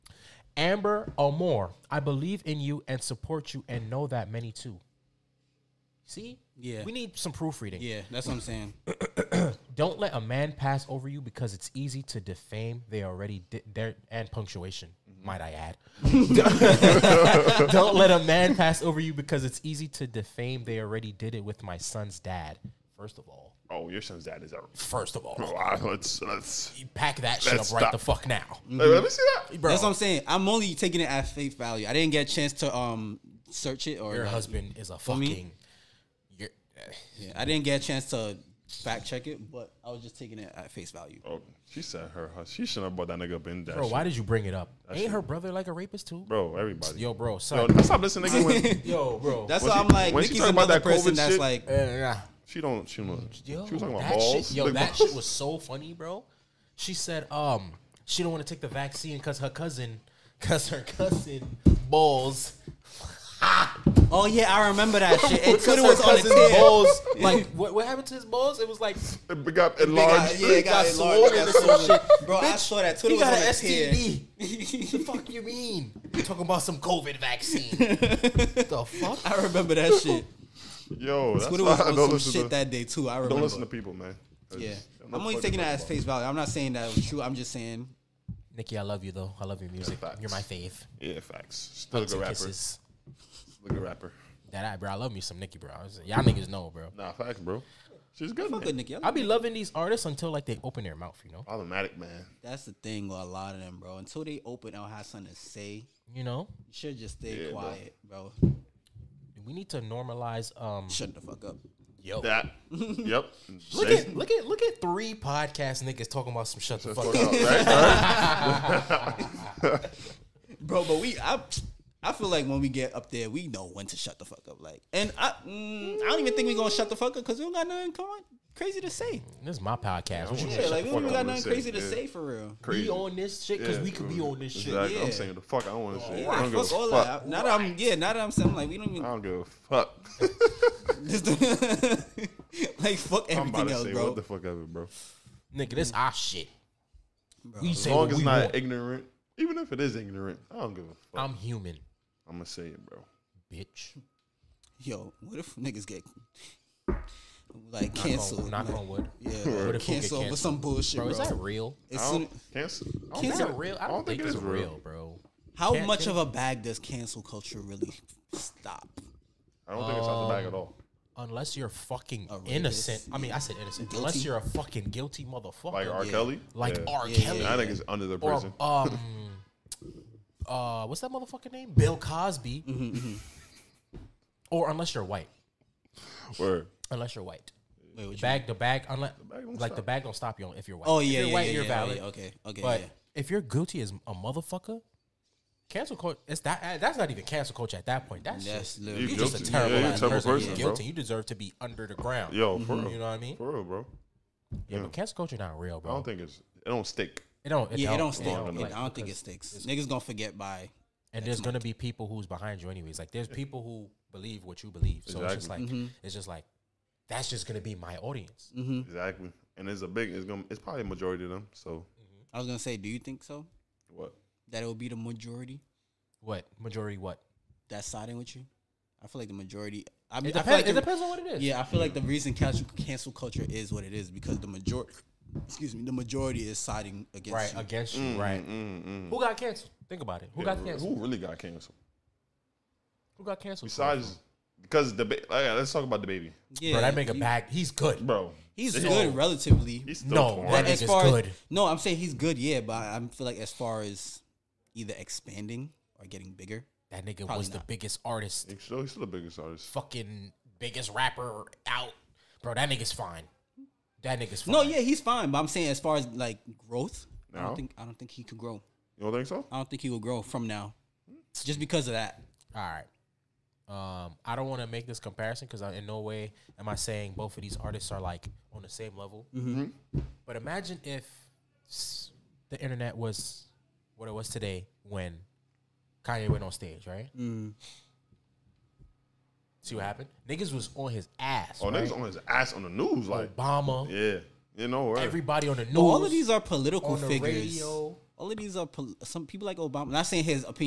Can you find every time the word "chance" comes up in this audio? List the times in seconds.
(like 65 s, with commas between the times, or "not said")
32 s, 37 s.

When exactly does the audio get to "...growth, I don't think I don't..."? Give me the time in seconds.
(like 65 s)
266 s.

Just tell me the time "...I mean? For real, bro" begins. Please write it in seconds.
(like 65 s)
203 s.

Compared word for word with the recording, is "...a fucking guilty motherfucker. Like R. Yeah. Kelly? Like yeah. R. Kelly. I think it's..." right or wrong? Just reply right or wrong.
right.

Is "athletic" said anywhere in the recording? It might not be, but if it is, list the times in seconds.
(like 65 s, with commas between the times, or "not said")
not said.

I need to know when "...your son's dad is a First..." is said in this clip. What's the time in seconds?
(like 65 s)
23 s.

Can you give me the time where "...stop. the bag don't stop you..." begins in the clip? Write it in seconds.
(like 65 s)
189 s.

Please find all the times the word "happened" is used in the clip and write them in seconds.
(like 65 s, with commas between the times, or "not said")
67 s, 289 s.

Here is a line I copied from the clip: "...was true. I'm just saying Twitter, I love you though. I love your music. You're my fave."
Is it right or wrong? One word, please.
wrong.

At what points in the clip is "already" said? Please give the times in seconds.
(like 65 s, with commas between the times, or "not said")
13 s, 20 s.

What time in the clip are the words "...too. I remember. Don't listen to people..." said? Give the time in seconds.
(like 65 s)
82 s.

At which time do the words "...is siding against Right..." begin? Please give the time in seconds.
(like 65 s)
236 s.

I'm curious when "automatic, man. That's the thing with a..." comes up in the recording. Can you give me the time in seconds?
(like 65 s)
101 s.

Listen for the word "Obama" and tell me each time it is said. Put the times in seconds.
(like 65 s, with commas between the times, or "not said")
293 s, 299 s.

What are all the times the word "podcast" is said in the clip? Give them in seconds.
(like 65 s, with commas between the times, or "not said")
115 s, 129 s.